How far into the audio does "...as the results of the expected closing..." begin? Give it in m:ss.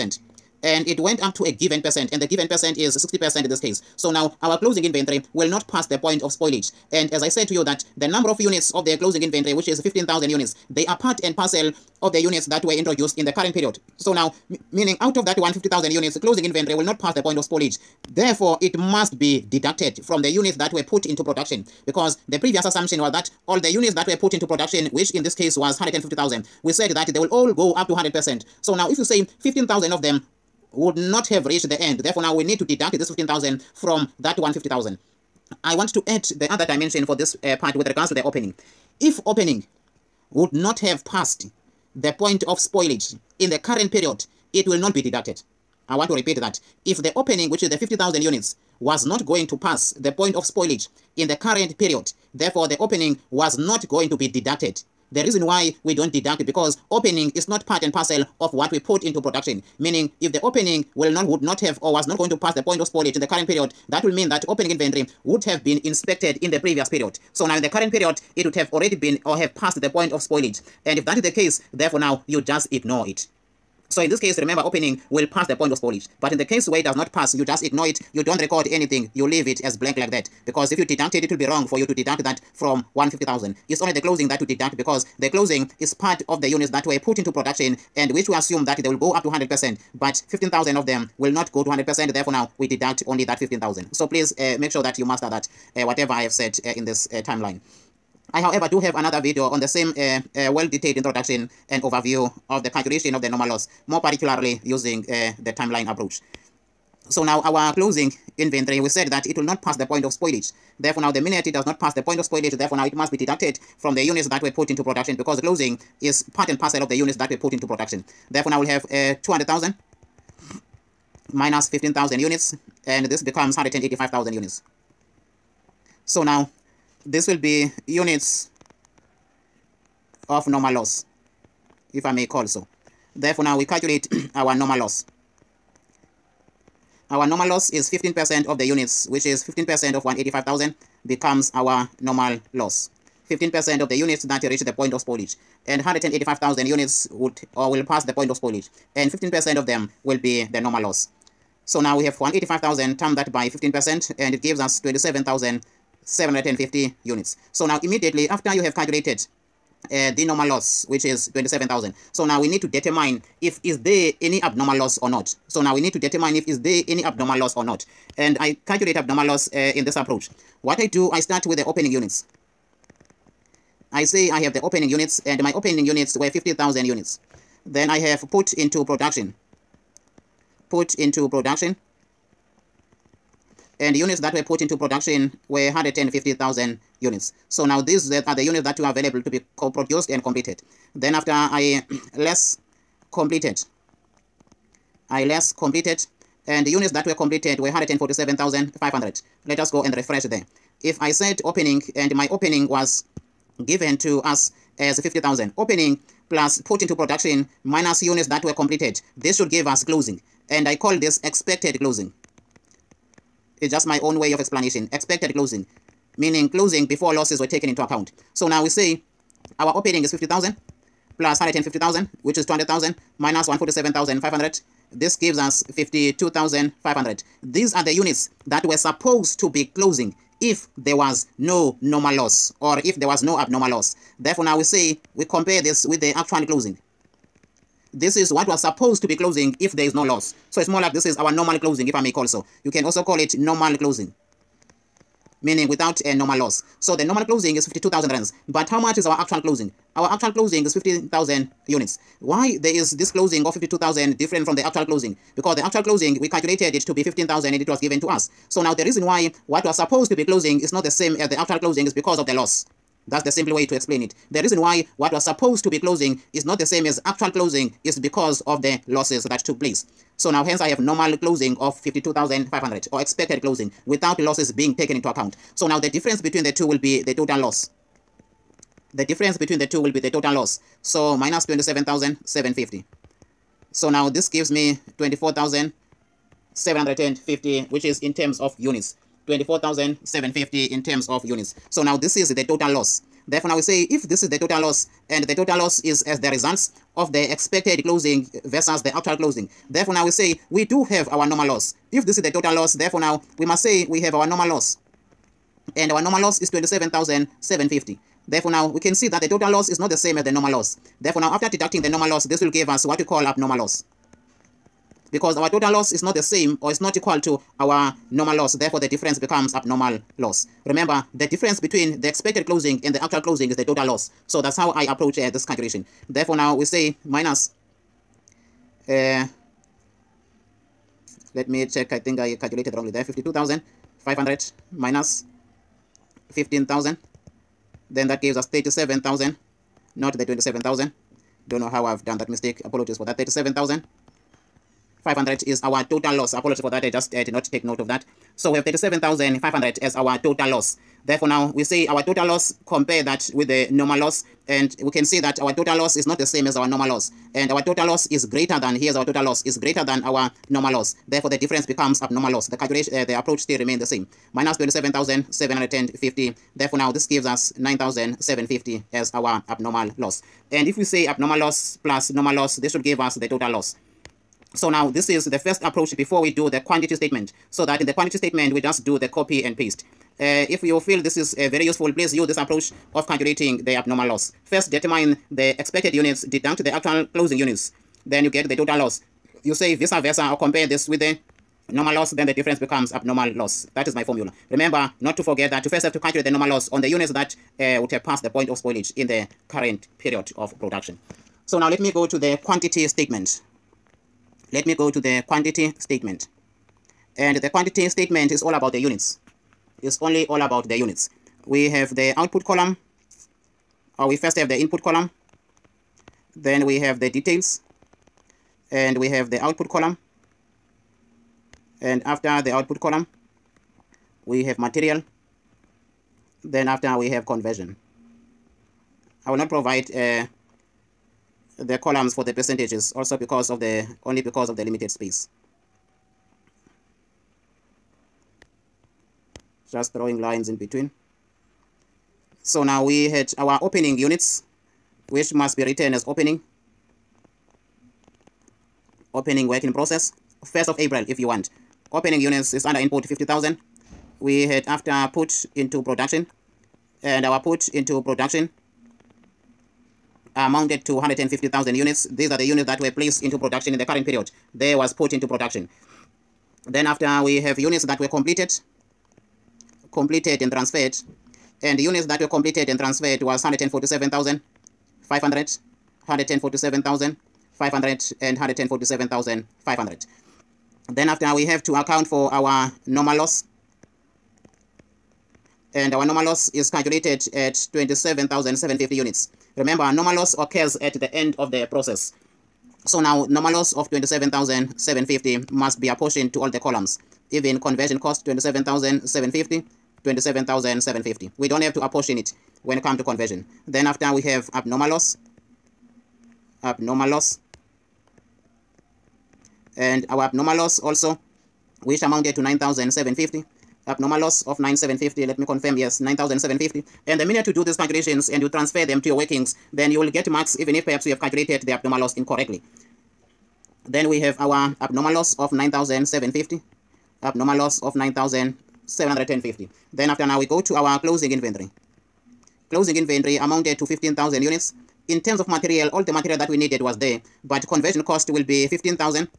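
4:56.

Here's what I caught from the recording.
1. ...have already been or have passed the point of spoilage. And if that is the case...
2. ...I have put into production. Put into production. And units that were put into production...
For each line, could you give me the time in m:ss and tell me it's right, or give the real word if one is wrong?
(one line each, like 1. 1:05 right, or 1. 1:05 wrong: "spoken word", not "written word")
1. 1:08 right
2. 2:57 right.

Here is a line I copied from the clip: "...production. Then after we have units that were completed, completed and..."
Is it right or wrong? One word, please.
right.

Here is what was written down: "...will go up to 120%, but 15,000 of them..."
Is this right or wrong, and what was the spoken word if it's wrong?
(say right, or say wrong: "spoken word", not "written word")
wrong: "100", not "120".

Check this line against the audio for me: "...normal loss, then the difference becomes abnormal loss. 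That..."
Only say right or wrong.
right.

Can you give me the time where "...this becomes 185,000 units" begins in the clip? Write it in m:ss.
2:03.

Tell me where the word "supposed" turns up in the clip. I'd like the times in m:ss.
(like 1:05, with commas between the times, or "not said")
3:48, 3:58, 4:19, 4:25.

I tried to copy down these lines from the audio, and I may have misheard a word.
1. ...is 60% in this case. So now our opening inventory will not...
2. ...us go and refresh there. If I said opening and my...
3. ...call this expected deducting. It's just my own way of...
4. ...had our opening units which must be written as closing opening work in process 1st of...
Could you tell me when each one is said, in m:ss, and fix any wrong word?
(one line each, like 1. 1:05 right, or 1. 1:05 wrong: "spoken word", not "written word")
1. 0:02 wrong: "closing", not "opening"
2. 3:19 right
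3. 3:30 wrong: "closing", not "deducting"
4. 7:23 wrong: "opening", not "closing".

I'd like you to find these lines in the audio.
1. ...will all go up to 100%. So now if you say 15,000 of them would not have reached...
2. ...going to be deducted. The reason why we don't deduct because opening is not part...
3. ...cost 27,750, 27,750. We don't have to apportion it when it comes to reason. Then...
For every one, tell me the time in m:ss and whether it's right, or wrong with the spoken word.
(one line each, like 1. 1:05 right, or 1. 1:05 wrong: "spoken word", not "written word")
1. 0:27 right
2. 0:53 right
3. 8:17 wrong: "conversion", not "reason".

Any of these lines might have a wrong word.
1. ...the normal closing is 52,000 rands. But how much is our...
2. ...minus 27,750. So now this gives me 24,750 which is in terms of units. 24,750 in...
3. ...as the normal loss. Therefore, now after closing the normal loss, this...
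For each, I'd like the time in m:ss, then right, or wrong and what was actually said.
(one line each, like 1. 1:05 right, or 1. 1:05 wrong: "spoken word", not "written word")
1. 4:06 right
2. 4:41 right
3. 5:10 wrong: "deducting", not "closing".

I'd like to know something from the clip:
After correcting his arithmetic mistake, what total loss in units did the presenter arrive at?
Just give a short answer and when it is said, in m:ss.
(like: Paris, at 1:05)
37,500, at 5:43.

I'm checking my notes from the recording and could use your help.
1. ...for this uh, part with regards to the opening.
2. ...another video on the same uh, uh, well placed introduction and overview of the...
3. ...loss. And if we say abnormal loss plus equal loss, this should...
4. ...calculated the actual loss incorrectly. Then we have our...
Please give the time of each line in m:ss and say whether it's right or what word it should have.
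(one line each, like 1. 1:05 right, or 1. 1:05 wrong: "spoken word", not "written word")
1. 0:37 right
2. 1:38 wrong: "detailed", not "placed"
3. 6:09 wrong: "normal", not "equal"
4. 8:41 wrong: "abnormal", not "actual".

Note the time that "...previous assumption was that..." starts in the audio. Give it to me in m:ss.
0:22.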